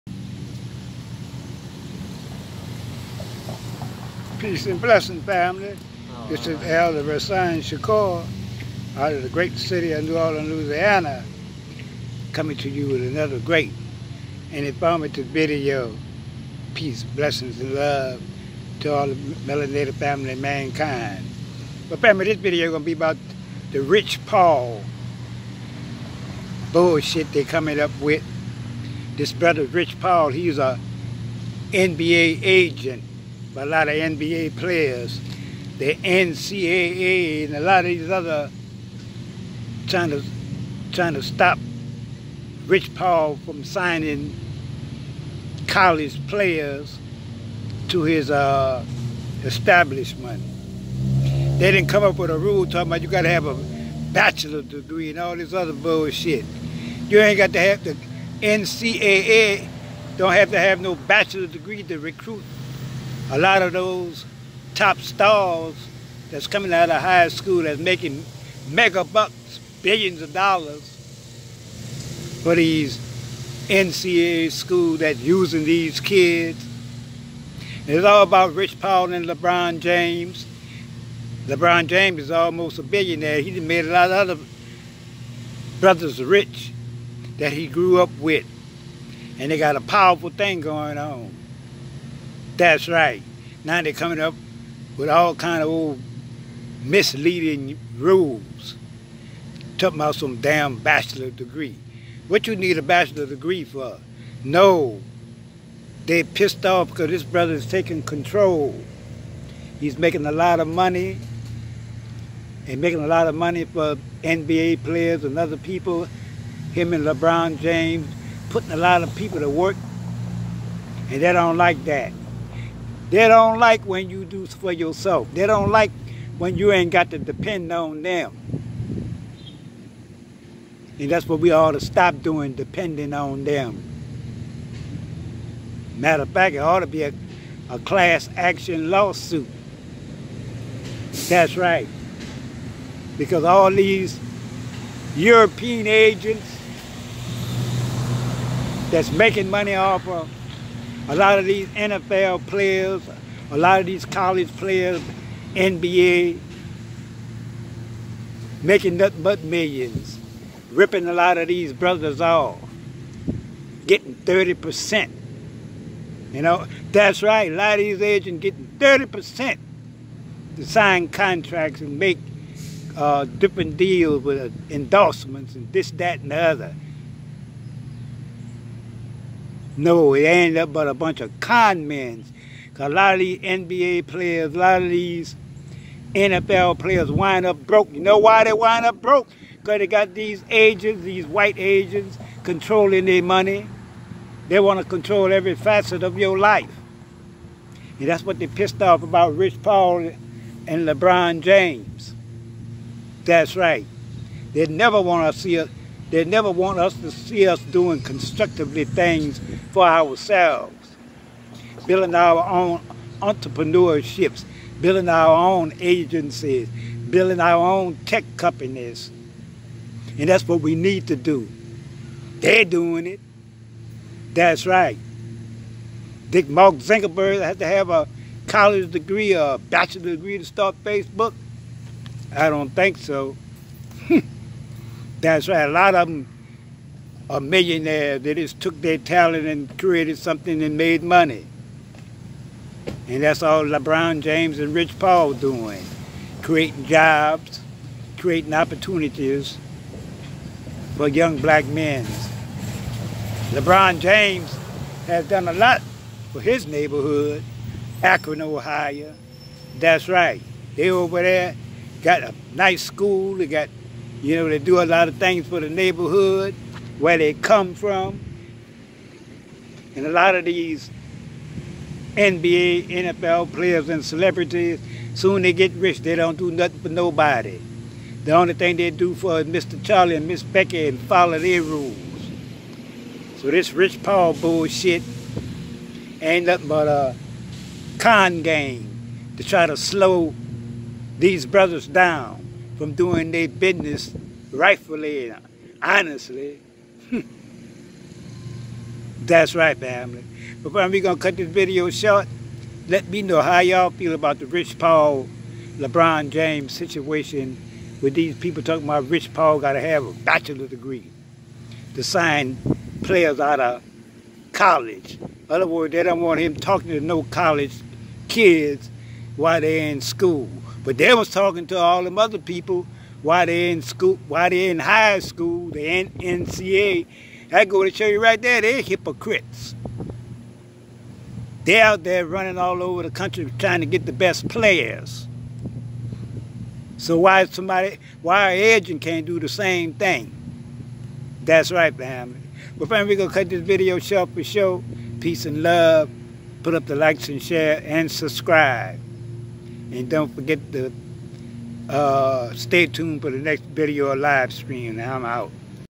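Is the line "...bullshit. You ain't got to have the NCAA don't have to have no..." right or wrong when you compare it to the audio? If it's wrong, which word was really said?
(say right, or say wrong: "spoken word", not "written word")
right.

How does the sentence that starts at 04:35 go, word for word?
They don't do nothing for nobody.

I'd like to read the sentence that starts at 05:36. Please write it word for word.
So why somebody, why agent can't do the same thing?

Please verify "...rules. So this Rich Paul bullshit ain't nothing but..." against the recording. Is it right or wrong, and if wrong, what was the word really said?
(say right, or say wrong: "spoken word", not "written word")
right.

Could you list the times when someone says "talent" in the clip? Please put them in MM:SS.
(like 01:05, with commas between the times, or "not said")
03:58.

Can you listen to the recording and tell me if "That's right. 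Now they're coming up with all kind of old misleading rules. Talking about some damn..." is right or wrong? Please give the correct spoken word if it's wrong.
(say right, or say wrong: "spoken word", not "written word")
right.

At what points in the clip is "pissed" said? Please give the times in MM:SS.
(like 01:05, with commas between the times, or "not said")
01:46, 03:18.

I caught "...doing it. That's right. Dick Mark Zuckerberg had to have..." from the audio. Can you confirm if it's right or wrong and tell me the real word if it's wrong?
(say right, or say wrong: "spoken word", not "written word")
right.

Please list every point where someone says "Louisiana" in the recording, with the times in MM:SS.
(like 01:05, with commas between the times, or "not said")
00:10.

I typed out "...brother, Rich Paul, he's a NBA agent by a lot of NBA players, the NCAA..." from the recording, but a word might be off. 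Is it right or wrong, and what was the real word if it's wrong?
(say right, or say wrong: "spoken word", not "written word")
right.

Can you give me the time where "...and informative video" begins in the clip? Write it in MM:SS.
00:14.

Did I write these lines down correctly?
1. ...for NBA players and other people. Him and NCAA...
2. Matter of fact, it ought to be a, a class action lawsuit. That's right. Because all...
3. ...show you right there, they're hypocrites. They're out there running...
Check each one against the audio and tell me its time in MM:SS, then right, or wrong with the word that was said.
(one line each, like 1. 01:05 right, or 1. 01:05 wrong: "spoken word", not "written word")
1. 01:53 wrong: "LeBron", not "NCAA"
2. 02:15 right
3. 05:27 right.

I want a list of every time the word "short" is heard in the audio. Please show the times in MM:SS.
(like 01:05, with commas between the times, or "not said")
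05:01, 05:43.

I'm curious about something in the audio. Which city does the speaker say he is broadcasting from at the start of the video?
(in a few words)
New Orleans.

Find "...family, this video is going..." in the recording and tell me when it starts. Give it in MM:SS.
00:21.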